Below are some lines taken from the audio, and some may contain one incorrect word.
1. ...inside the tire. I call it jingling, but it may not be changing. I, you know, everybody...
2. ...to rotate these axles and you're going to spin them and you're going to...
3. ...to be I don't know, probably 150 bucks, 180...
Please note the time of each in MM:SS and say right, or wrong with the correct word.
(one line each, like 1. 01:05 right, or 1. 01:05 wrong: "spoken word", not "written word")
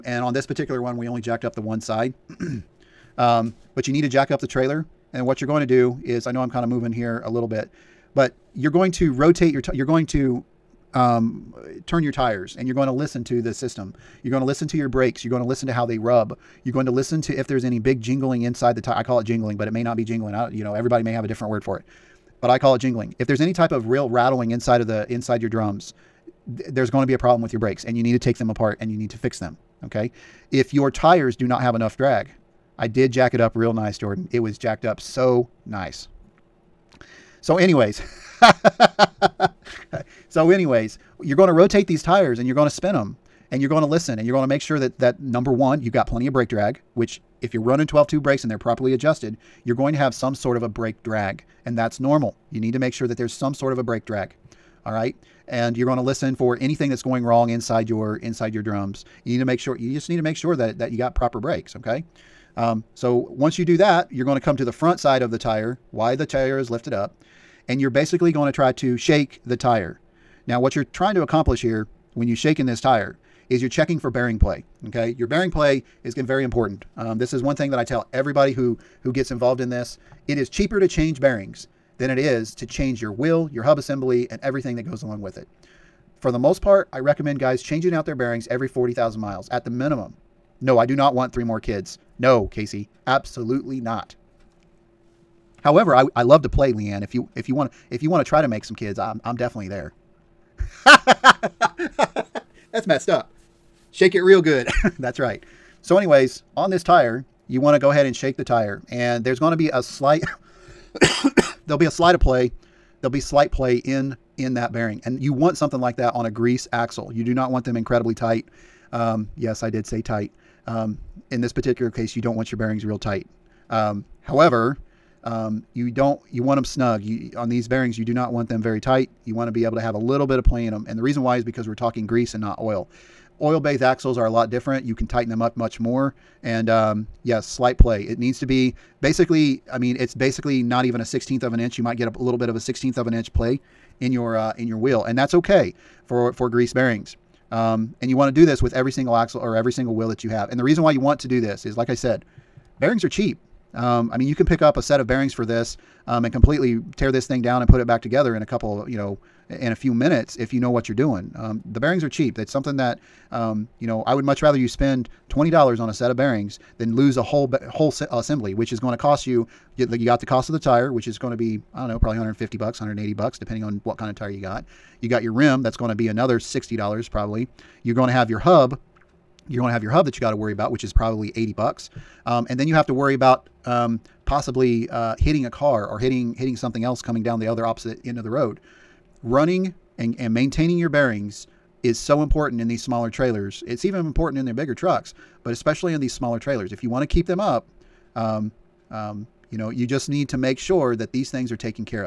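1. 00:18 wrong: "jingling", not "changing"
2. 00:41 wrong: "tires", not "axles"
3. 02:51 right.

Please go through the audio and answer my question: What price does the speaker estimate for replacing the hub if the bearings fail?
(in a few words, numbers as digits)
$80.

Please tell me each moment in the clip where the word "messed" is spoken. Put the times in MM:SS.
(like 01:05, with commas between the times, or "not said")
01:42.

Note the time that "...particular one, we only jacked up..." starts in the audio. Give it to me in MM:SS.
00:00.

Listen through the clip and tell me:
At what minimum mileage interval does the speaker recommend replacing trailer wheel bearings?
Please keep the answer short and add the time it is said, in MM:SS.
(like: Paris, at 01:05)
40,000 miles, at 01:28.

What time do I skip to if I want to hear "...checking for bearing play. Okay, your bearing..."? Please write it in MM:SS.
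01:13.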